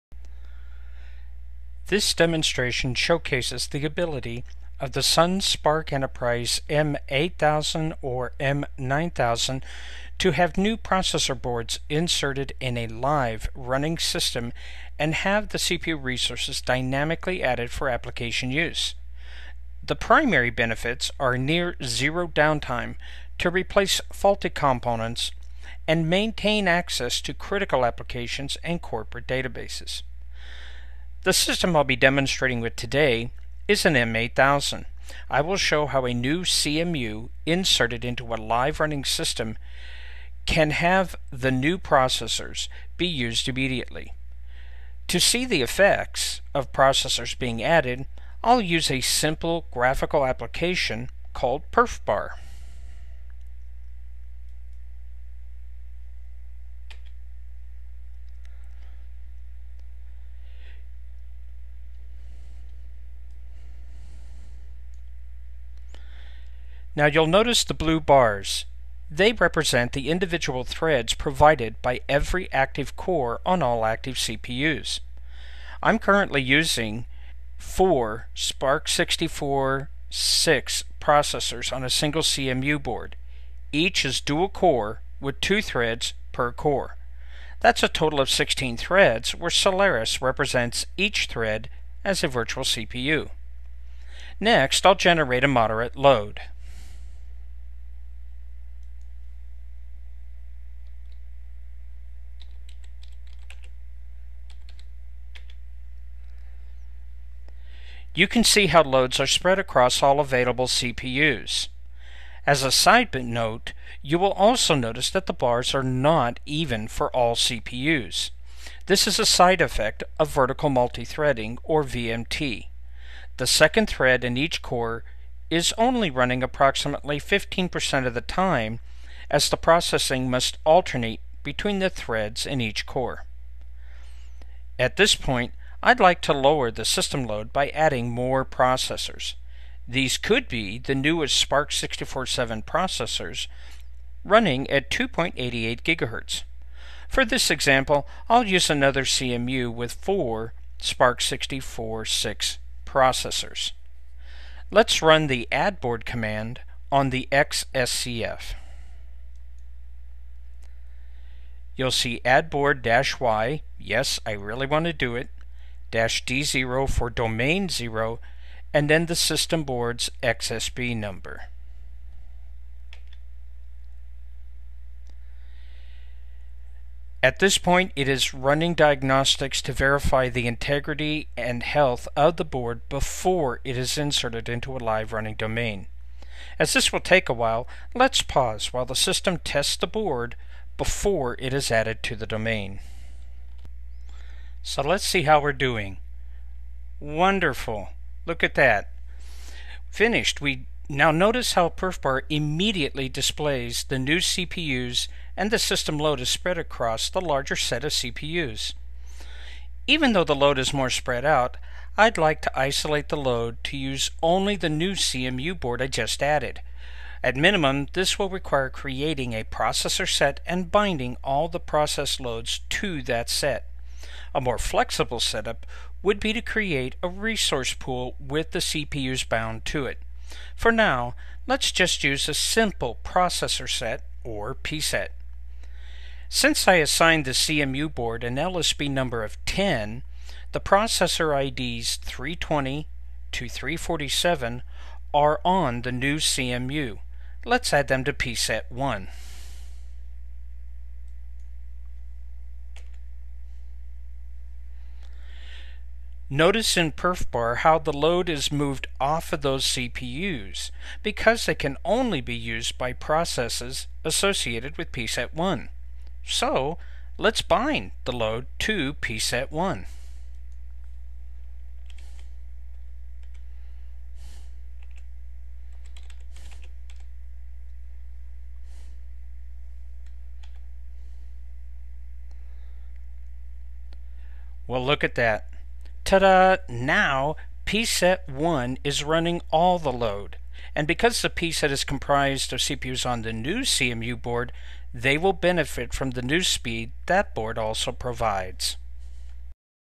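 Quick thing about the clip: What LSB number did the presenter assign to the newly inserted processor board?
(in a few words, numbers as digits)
10.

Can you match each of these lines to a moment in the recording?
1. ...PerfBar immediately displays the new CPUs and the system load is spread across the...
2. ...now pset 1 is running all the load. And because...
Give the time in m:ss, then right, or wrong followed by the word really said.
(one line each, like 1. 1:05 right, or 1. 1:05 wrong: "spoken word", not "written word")
1. 3:21 right
2. 4:46 right.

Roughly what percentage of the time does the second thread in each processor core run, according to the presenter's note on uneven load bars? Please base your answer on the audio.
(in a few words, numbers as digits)
15%.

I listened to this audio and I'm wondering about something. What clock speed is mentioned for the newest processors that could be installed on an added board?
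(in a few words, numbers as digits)
2.88 GHz.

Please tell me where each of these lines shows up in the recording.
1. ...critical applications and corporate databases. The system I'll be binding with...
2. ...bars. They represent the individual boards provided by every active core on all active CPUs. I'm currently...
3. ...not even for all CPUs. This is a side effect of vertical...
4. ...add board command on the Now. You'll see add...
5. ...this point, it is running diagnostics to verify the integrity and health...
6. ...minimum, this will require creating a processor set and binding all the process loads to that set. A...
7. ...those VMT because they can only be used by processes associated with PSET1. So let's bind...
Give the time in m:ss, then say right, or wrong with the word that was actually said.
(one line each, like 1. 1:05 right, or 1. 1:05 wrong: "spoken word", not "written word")
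1. 0:27 wrong: "demonstrating", not "binding"
2. 1:08 wrong: "threads", not "boards"
3. 1:55 right
4. 2:35 wrong: "XSCF", not "Now"
5. 2:57 right
6. 3:37 right
7. 4:19 wrong: "CPUs", not "VMT".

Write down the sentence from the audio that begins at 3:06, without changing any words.
As this will take a while, let's pause while the system tests the board before it is added to the domain.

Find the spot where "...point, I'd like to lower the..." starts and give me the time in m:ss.
2:15.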